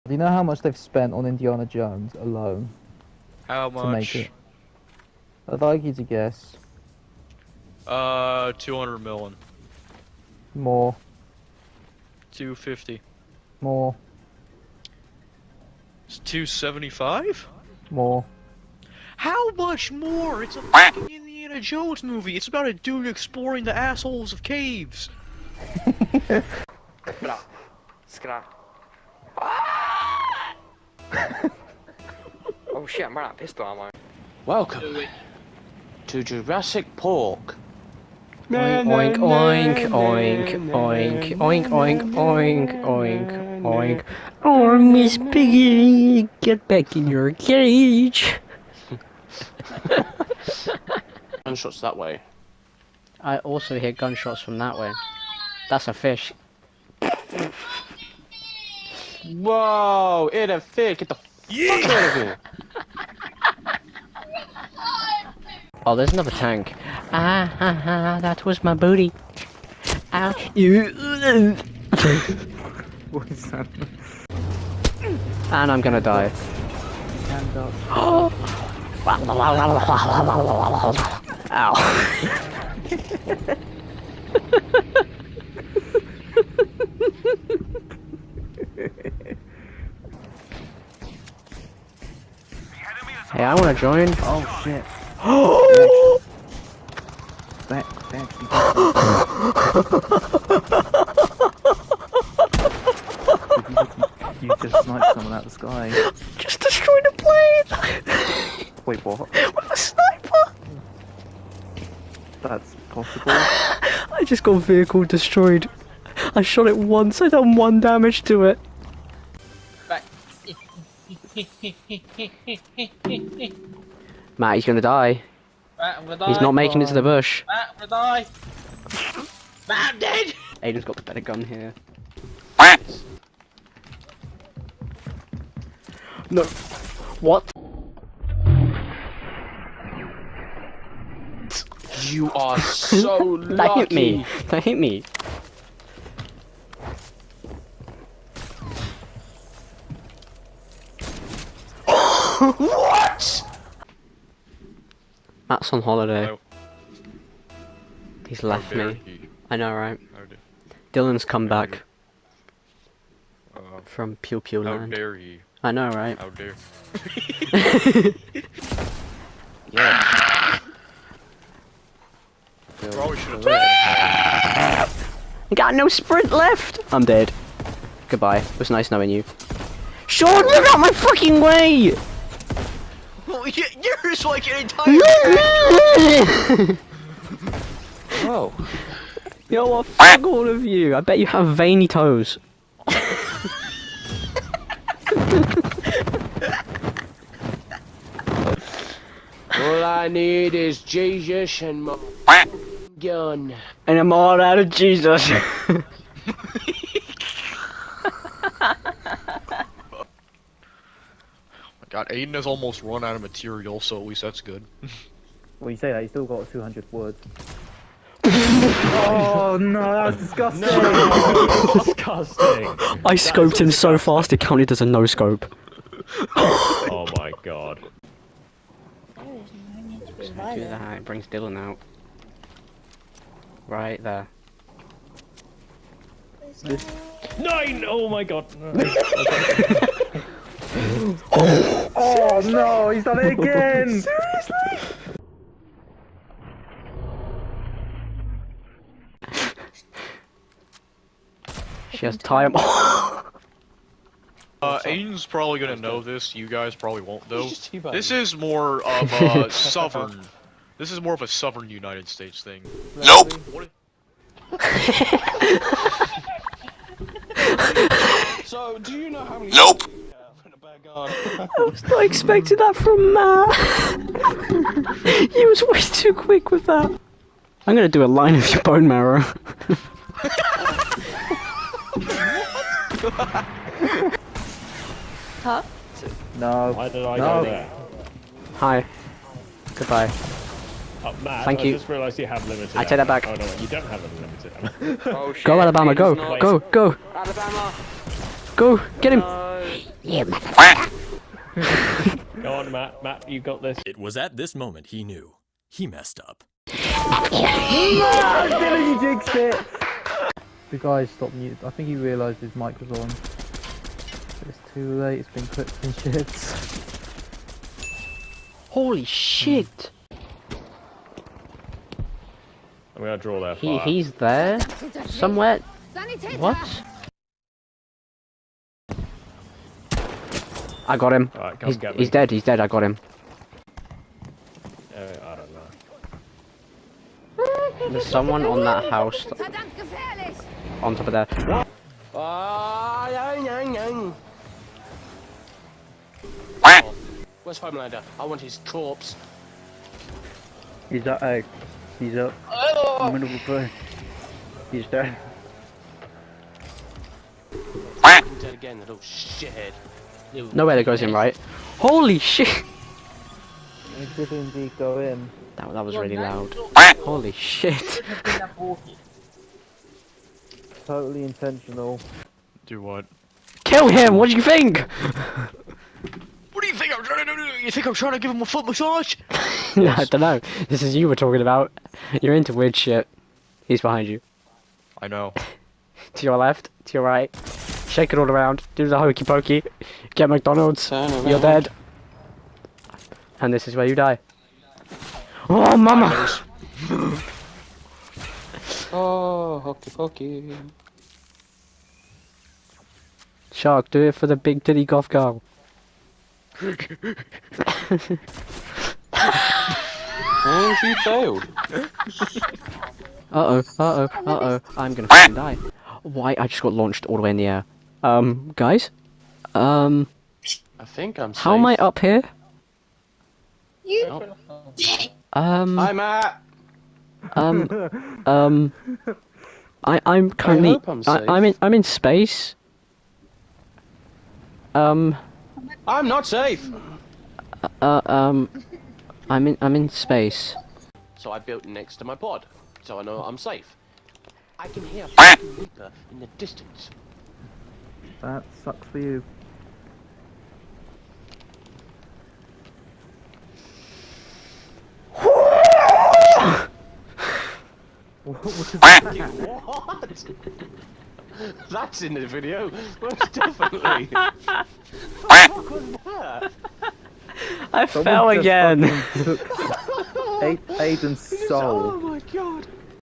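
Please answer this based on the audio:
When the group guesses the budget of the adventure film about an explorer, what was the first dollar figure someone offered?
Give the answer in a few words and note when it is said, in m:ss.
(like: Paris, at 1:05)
200 million, at 0:08.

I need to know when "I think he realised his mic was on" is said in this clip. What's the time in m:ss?
5:11.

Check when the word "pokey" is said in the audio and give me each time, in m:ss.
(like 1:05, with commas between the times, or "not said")
6:29, 6:39.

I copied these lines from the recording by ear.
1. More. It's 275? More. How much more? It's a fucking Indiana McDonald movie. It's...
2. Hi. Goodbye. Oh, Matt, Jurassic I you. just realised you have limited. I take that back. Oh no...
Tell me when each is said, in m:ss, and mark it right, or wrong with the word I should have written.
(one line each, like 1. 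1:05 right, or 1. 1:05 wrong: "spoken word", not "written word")
1. 0:13 wrong: "Jones", not "McDonald"
2. 4:48 wrong: "Thank", not "Jurassic".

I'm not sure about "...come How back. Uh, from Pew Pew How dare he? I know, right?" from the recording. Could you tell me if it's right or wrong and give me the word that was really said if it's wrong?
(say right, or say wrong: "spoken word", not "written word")
right.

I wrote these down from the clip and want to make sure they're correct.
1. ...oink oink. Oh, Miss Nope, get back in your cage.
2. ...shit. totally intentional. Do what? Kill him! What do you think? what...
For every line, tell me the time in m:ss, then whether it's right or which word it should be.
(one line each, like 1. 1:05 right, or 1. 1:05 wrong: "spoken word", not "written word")
1. 0:42 wrong: "Piggy", not "Nope"
2. 6:07 right.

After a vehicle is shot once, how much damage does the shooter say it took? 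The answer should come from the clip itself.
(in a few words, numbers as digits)
1.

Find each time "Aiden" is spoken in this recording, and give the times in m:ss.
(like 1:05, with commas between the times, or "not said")
2:10, 3:32, 4:14, 7:50.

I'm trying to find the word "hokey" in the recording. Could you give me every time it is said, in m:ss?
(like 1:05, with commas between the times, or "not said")
6:28, 6:39.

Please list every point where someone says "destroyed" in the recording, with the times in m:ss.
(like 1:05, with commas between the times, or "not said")
1:46, 1:55.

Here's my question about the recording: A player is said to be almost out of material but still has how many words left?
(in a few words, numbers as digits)
200.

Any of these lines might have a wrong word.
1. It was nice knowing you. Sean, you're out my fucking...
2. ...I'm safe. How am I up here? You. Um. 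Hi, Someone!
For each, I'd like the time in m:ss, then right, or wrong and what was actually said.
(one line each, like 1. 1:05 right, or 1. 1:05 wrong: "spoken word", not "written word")
1. 2:58 right
2. 7:01 wrong: "Matt", not "Someone".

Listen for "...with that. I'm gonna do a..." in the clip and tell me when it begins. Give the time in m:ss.
4:36.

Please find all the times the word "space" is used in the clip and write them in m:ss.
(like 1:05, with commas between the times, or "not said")
7:11, 7:19.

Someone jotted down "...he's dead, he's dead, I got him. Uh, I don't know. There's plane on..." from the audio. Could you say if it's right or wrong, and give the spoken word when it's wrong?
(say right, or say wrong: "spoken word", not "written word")
wrong: "someone", not "plane".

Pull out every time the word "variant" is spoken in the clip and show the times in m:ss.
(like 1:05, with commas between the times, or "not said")
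not said.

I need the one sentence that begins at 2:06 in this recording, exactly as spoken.
He's not making it to the bush.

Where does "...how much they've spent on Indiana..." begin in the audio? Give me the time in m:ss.
0:00.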